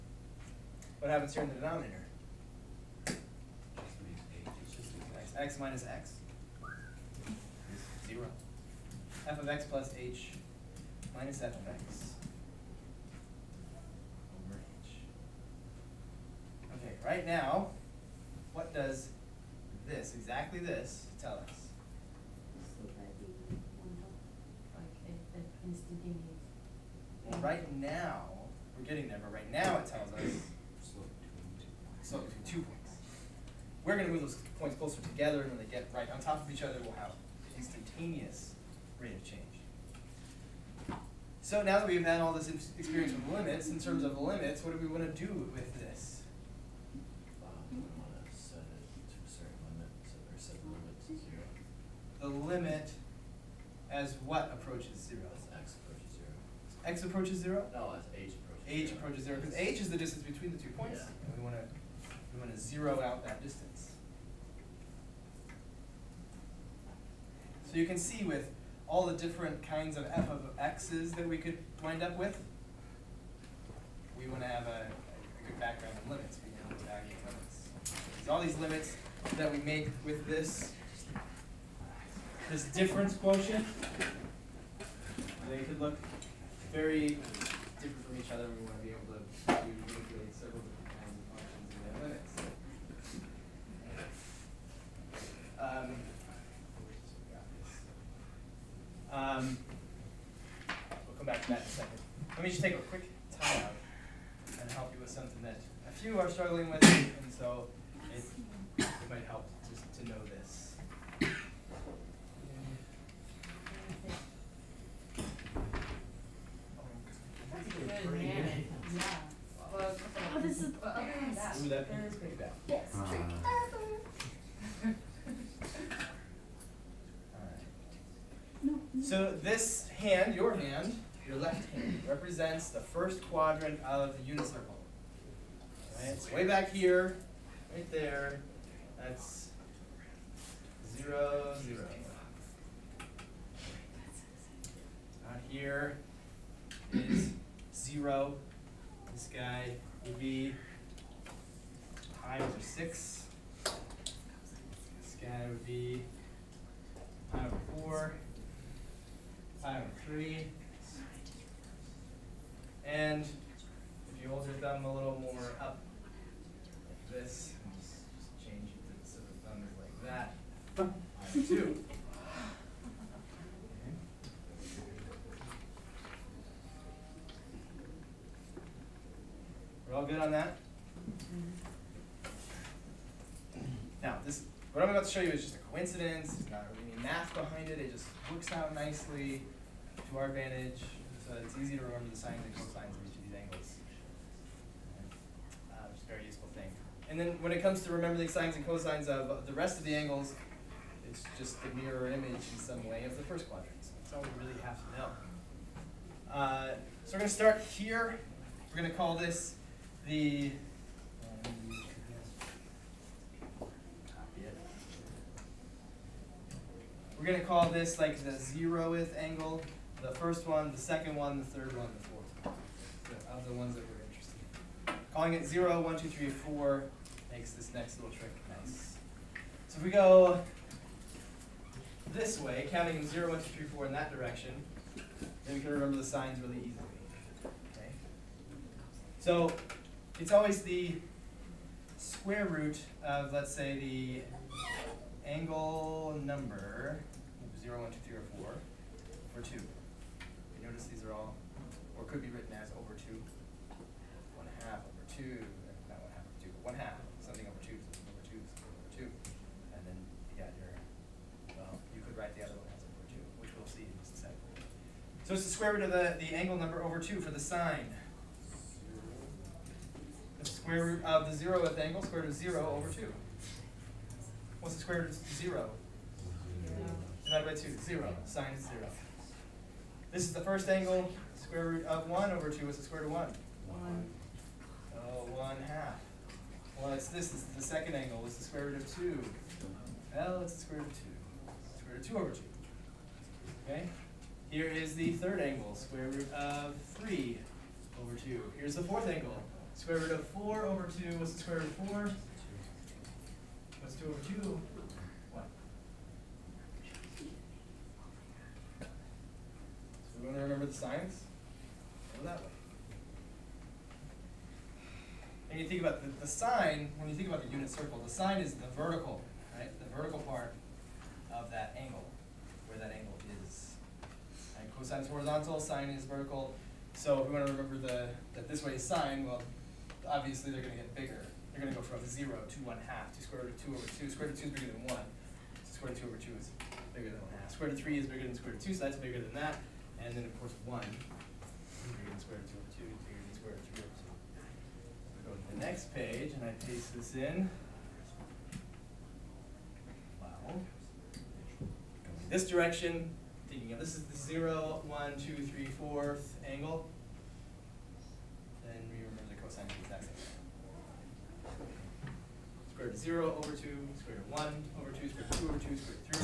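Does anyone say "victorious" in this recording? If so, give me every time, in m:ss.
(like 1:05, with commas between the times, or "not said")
not said.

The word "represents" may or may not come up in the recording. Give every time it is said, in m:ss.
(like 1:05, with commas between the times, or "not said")
2:12.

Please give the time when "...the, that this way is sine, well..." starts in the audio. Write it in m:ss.
5:27.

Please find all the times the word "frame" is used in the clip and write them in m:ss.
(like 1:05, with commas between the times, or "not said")
not said.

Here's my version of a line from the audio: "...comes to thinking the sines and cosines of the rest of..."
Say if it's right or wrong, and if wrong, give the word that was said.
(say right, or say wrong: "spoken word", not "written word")
wrong: "remembering", not "thinking".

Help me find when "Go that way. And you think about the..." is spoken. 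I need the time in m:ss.
5:12.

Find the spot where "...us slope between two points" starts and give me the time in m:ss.
0:30.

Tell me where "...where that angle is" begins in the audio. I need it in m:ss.
5:22.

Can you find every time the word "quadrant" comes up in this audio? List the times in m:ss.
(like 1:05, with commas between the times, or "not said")
2:13, 3:23.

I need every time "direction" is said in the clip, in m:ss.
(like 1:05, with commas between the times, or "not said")
3:54, 5:52.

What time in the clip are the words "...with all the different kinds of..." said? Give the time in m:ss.
1:08.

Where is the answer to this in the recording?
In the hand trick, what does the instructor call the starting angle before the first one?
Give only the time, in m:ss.
3:38.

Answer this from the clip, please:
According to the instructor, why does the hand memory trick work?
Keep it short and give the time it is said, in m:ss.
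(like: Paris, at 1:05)
just a coincidence, at 3:05.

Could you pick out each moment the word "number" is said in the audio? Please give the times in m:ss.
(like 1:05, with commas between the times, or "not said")
4:06, 4:26.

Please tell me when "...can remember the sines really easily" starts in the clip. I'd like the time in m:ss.
3:55.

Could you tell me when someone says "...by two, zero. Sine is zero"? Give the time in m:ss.
4:37.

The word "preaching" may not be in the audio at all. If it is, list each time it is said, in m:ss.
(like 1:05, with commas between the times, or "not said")
not said.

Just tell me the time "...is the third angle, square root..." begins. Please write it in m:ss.
4:54.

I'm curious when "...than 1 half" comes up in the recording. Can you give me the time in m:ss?
5:37.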